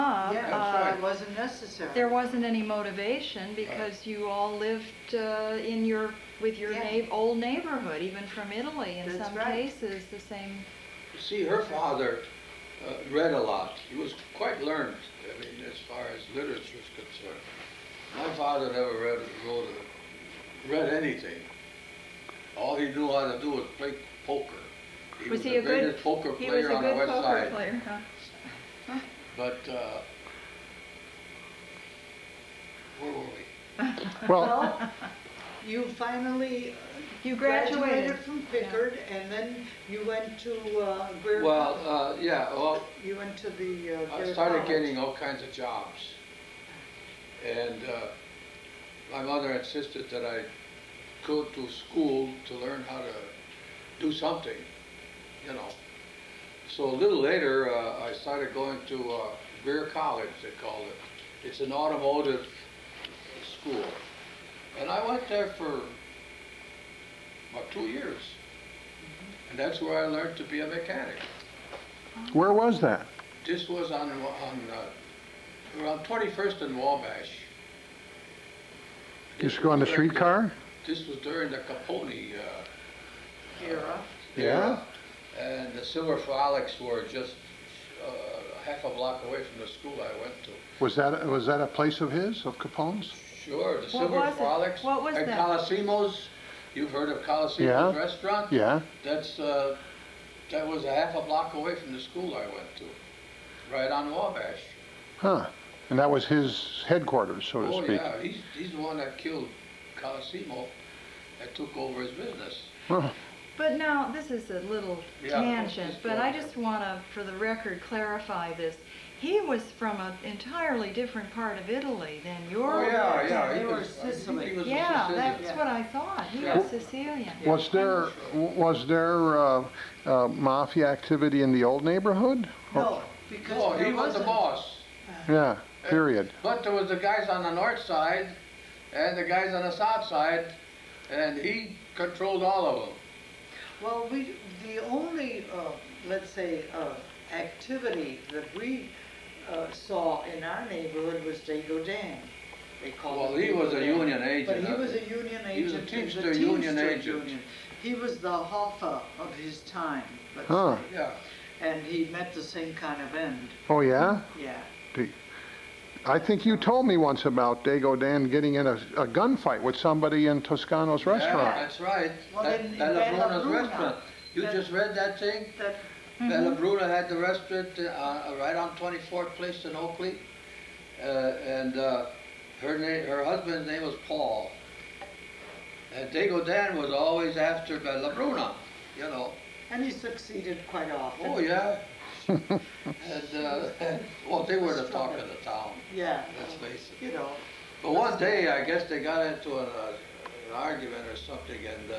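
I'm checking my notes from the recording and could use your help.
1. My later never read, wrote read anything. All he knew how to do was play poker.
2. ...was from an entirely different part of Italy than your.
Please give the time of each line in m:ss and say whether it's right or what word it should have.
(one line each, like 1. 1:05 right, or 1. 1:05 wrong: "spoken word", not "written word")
1. 0:18 wrong: "father", not "later"
2. 1:59 right.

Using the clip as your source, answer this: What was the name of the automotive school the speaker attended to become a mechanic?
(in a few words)
Greer College.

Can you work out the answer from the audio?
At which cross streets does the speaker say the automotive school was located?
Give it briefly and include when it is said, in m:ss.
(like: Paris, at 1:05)
21st and Wabash, at 1:16.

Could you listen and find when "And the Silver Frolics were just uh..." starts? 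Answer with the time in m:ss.
1:25.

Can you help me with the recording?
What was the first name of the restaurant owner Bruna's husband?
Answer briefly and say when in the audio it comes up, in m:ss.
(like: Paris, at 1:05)
Paul, at 3:04.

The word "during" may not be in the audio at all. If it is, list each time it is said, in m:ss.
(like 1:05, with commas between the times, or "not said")
1:21.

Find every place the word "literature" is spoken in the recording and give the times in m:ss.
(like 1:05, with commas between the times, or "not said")
0:16.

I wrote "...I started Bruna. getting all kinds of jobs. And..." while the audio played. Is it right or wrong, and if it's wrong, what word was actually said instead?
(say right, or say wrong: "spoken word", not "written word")
wrong: "College", not "Bruna".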